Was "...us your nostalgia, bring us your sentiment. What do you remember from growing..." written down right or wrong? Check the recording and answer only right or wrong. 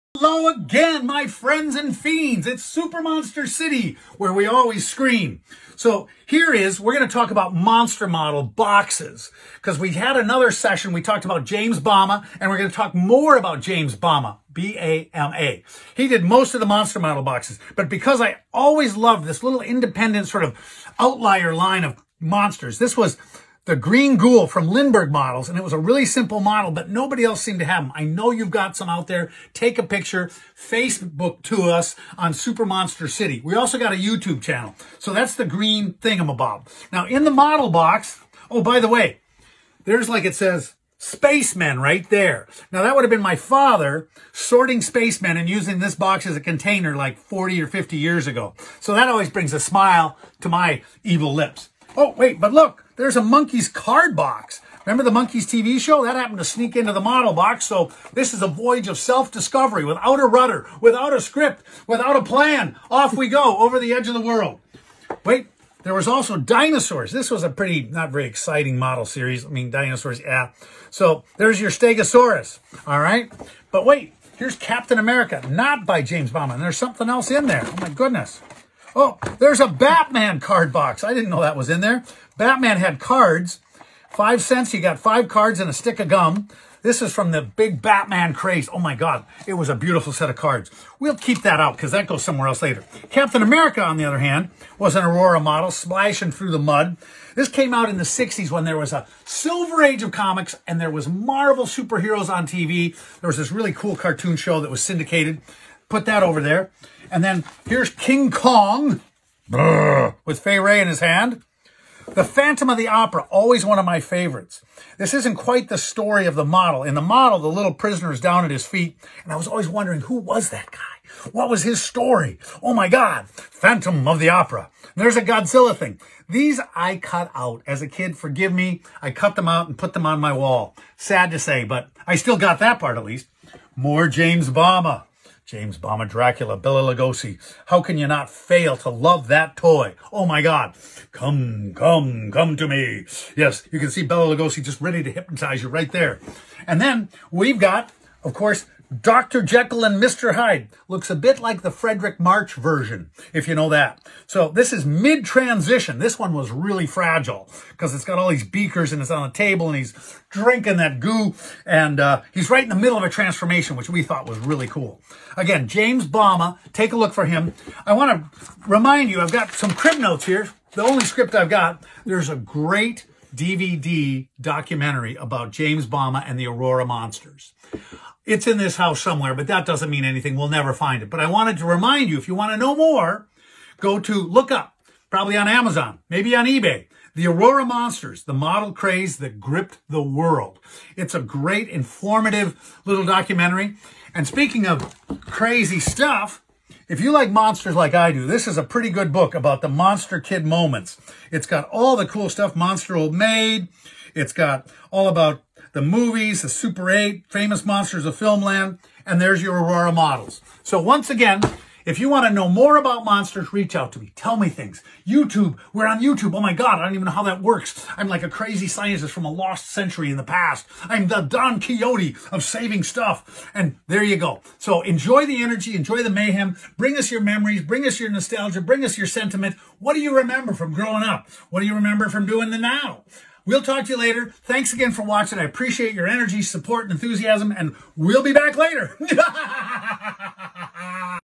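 right.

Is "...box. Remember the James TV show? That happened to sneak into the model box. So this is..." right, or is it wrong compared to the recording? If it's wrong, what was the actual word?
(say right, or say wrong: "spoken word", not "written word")
wrong: "Monkees", not "James".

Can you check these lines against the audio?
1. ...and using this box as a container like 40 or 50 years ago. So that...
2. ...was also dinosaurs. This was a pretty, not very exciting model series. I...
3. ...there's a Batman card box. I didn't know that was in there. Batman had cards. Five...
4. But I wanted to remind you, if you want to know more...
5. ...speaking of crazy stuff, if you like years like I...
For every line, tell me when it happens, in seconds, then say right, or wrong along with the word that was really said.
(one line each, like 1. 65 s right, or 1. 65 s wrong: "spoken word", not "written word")
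1. 45 s right
2. 65 s right
3. 79 s right
4. 181 s right
5. 194 s wrong: "monsters", not "years".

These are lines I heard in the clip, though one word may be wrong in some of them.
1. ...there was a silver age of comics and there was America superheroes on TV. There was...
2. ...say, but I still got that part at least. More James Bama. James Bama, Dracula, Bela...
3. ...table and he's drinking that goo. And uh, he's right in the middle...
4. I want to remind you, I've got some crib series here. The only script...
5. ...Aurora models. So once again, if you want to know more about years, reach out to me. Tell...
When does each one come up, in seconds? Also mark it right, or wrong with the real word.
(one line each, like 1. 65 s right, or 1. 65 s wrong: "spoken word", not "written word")
1. 98 s wrong: "Marvel", not "America"
2. 131 s right
3. 159 s right
4. 167 s wrong: "notes", not "series"
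5. 209 s wrong: "monsters", not "years".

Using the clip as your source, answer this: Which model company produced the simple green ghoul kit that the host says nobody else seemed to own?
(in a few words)
Lindberg.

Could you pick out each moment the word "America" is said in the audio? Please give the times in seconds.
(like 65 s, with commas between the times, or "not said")
74 s, 93 s.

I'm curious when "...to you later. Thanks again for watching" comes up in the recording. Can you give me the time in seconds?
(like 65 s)
233 s.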